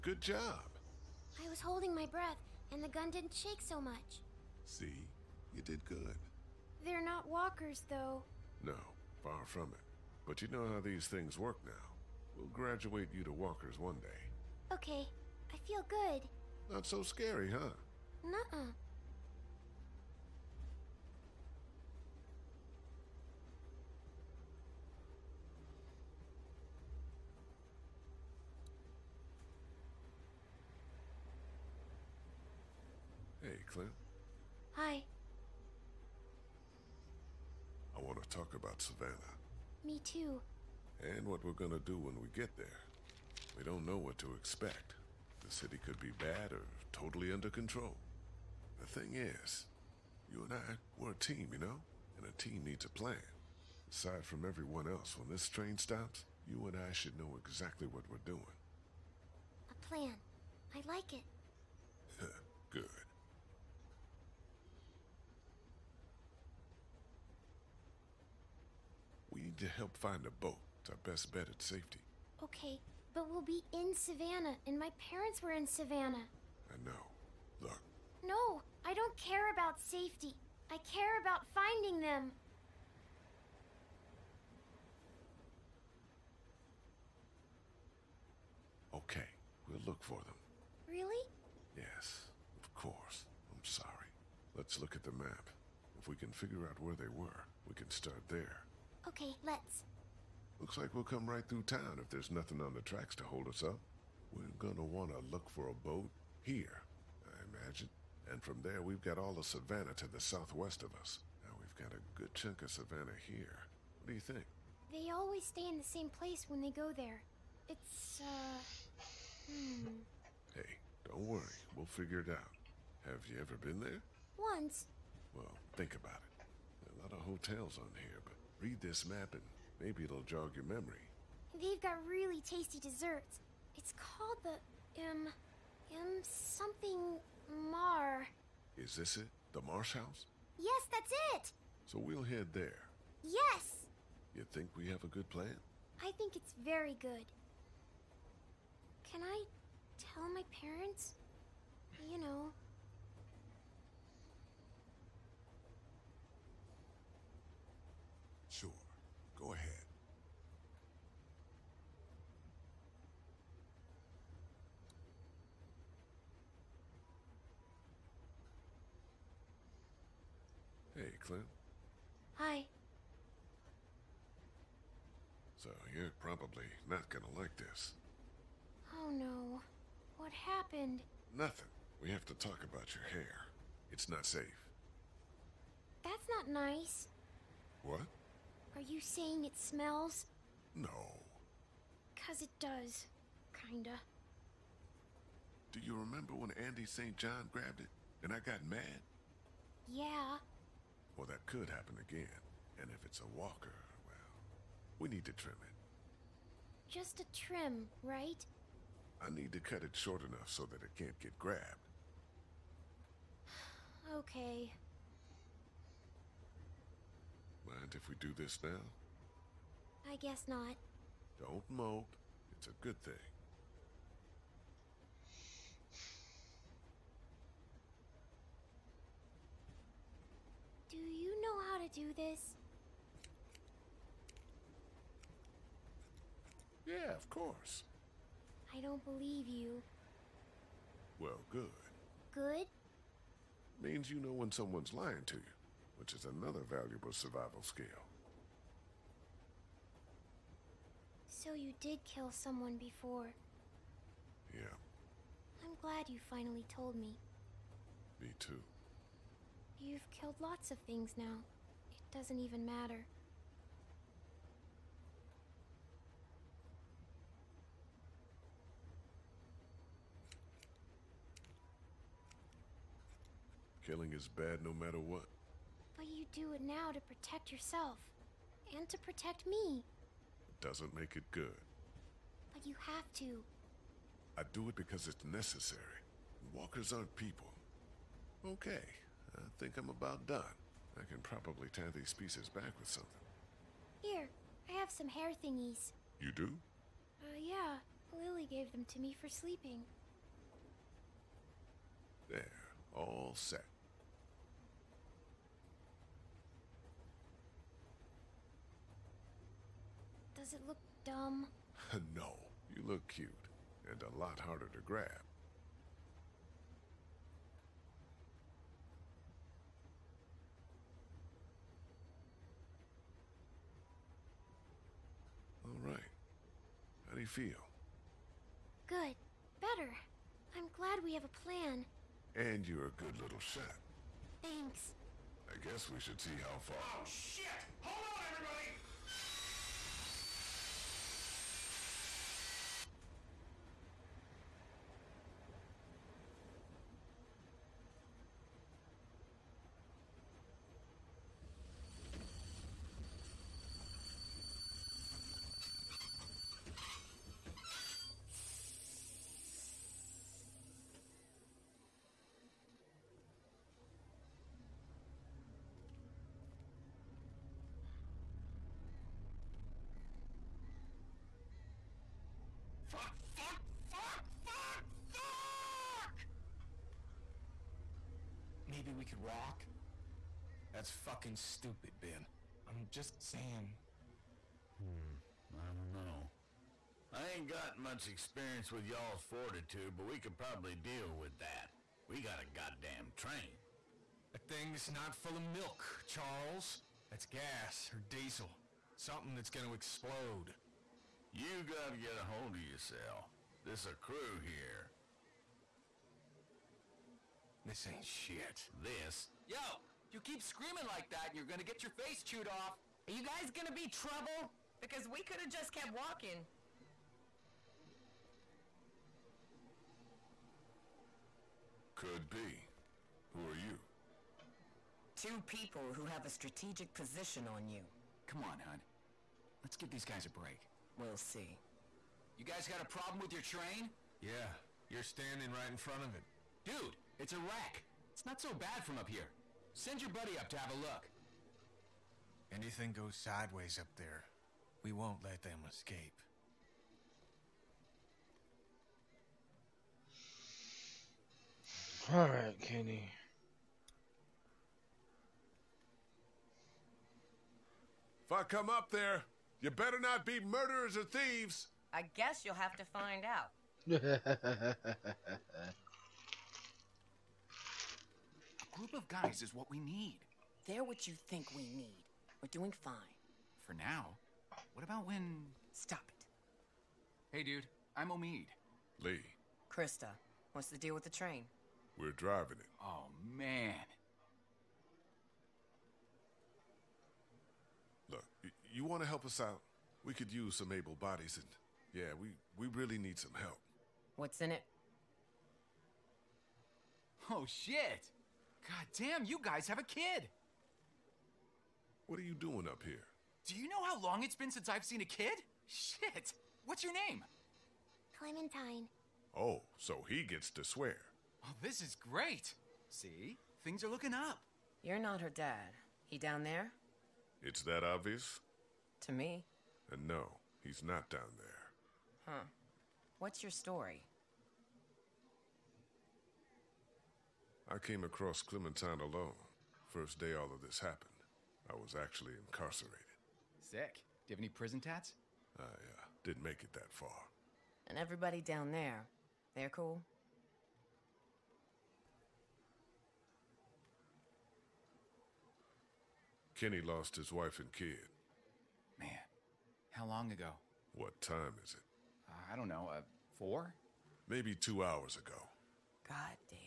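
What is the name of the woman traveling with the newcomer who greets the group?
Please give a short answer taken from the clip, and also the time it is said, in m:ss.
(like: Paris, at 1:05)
Christa, at 7:59.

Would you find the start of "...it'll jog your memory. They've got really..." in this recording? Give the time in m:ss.
2:10.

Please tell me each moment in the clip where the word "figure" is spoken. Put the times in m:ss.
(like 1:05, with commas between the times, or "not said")
1:36, 2:01.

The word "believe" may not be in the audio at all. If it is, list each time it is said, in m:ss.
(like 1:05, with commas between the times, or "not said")
3:59.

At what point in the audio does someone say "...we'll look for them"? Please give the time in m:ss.
1:29.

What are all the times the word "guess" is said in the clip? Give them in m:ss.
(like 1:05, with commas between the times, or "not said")
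3:40, 5:35, 7:42.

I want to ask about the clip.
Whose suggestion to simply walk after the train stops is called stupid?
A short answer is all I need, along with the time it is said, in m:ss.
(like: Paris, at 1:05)
Ben, at 6:21.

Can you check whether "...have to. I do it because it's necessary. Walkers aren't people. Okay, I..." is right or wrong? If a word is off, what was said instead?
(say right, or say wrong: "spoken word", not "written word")
right.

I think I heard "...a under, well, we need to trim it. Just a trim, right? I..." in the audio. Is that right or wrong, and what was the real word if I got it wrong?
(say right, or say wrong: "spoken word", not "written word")
wrong: "walker", not "under".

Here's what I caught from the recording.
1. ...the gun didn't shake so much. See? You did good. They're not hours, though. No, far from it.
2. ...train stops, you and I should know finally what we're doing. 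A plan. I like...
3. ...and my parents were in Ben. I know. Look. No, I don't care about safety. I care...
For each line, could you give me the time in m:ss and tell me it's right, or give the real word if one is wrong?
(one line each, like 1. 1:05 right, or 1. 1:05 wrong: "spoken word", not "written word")
1. 0:02 wrong: "walkers", not "hours"
2. 0:55 wrong: "exactly", not "finally"
3. 1:14 wrong: "Savannah", not "Ben".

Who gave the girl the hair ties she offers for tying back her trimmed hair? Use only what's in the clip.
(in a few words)
Lily.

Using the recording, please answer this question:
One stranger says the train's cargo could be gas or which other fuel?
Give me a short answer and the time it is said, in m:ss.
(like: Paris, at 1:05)
Diesel, at 6:38.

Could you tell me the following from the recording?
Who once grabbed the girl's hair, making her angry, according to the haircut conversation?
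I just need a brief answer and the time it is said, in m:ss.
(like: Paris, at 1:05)
Andy St. John, at 3:16.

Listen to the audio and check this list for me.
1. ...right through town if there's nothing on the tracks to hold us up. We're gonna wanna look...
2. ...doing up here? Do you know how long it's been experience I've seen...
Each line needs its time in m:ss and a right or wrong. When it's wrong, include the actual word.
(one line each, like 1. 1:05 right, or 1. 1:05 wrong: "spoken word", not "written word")
1. 1:41 right
2. 8:22 wrong: "since", not "experience".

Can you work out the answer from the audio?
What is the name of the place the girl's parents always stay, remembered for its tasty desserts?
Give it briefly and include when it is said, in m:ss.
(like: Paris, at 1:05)
The Marsh House, at 2:19.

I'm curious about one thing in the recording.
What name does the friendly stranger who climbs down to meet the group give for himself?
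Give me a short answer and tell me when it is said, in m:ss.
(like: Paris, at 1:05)
Omid, at 7:58.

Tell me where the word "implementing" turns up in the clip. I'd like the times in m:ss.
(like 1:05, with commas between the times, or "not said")
not said.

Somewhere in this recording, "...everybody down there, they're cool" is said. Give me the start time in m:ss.
8:57.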